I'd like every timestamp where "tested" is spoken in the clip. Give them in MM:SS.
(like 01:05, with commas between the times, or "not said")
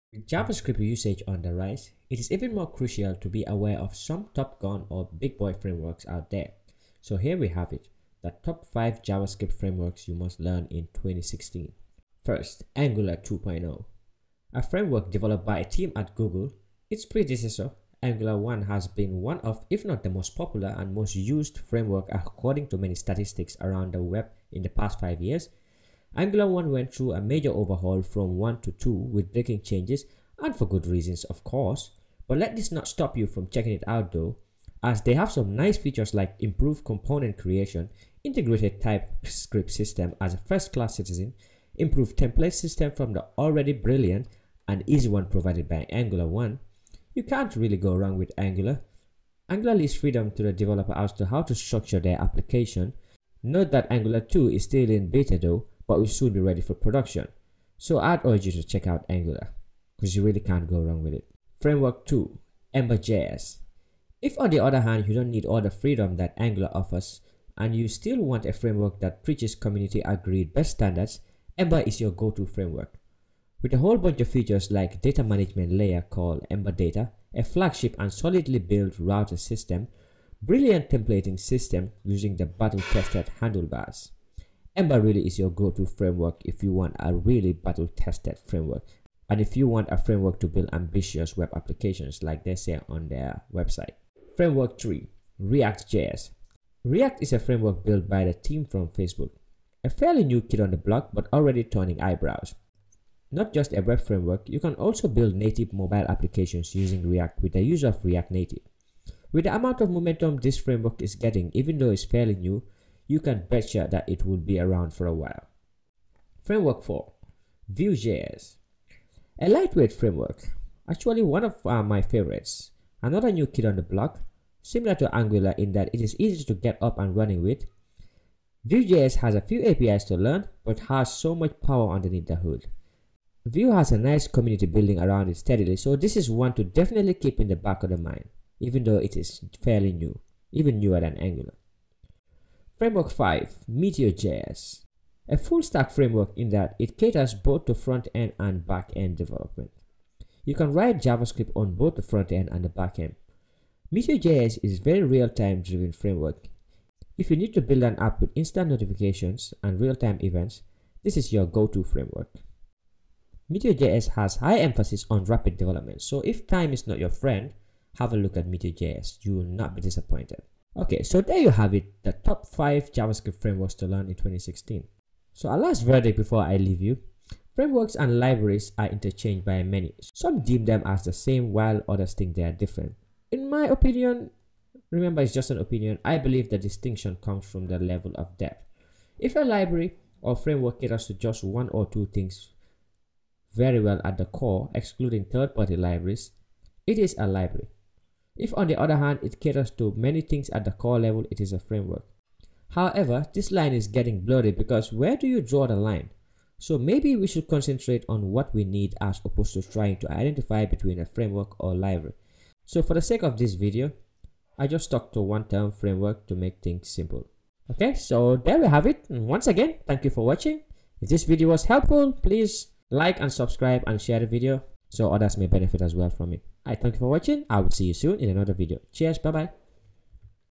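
01:22, 01:27.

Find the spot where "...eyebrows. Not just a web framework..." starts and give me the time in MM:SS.
01:42.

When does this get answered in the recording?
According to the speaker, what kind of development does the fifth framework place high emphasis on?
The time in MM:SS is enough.
02:45.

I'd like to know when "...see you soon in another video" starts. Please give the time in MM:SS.
03:47.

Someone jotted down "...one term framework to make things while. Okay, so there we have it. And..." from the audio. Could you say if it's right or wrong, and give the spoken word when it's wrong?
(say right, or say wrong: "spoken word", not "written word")
wrong: "simple", not "while".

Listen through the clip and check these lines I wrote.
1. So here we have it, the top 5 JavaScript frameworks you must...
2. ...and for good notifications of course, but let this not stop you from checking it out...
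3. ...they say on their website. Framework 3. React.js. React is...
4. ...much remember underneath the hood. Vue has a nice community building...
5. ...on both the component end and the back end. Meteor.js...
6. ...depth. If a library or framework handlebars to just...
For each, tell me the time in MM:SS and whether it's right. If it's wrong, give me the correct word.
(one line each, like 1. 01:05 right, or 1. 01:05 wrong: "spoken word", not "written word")
1. 00:06 right
2. 00:30 wrong: "reasons", not "notifications"
3. 01:32 right
4. 02:11 wrong: "power", not "remember"
5. 02:31 wrong: "front", not "component"
6. 03:08 wrong: "caters", not "handlebars".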